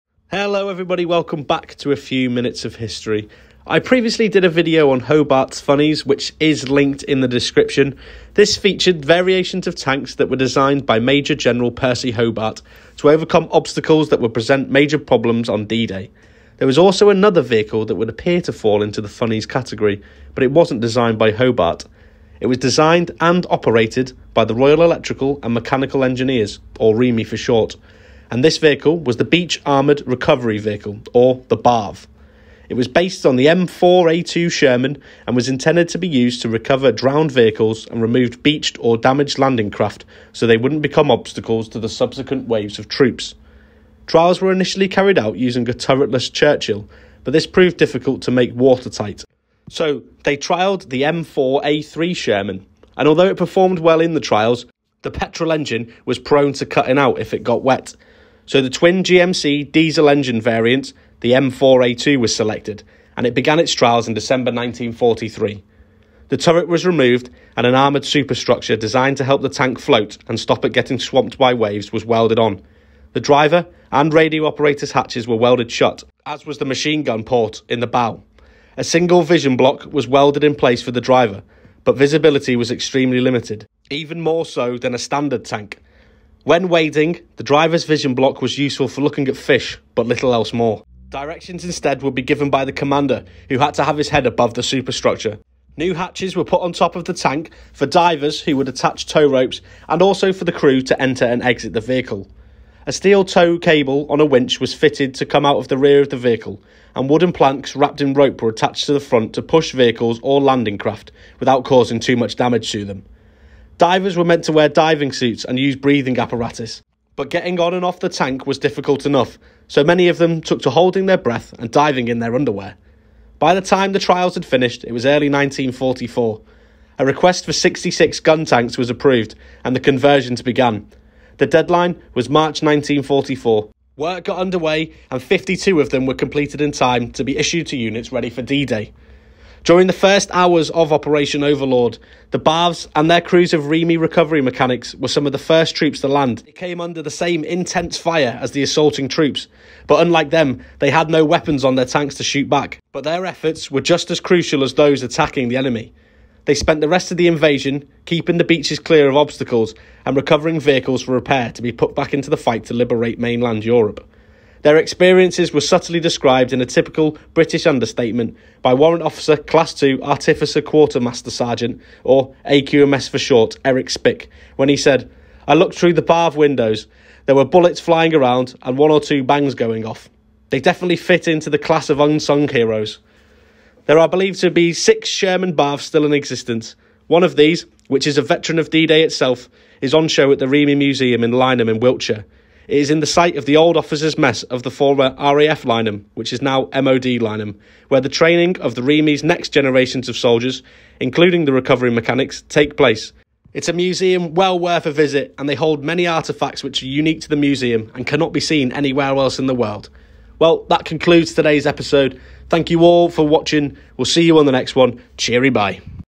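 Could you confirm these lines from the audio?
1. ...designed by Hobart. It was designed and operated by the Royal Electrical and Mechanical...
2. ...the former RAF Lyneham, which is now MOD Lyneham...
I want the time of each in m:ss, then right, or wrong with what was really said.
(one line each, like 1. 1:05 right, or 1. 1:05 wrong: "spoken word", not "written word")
1. 0:20 right
2. 3:14 right.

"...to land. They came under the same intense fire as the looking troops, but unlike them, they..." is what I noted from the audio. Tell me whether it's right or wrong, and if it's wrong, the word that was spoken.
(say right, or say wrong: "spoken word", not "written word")
wrong: "assaulting", not "looking".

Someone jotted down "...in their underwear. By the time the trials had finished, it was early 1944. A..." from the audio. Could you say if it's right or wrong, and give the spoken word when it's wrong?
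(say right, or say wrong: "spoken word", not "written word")
right.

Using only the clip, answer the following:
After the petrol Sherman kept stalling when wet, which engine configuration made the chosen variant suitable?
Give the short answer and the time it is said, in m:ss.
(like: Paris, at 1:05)
Twin GMC diesel, at 0:58.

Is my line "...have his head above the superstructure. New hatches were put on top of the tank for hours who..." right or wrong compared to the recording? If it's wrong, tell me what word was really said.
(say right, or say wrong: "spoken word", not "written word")
wrong: "divers", not "hours".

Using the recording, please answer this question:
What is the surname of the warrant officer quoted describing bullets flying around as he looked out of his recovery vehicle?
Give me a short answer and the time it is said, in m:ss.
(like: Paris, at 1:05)
Spick, at 2:53.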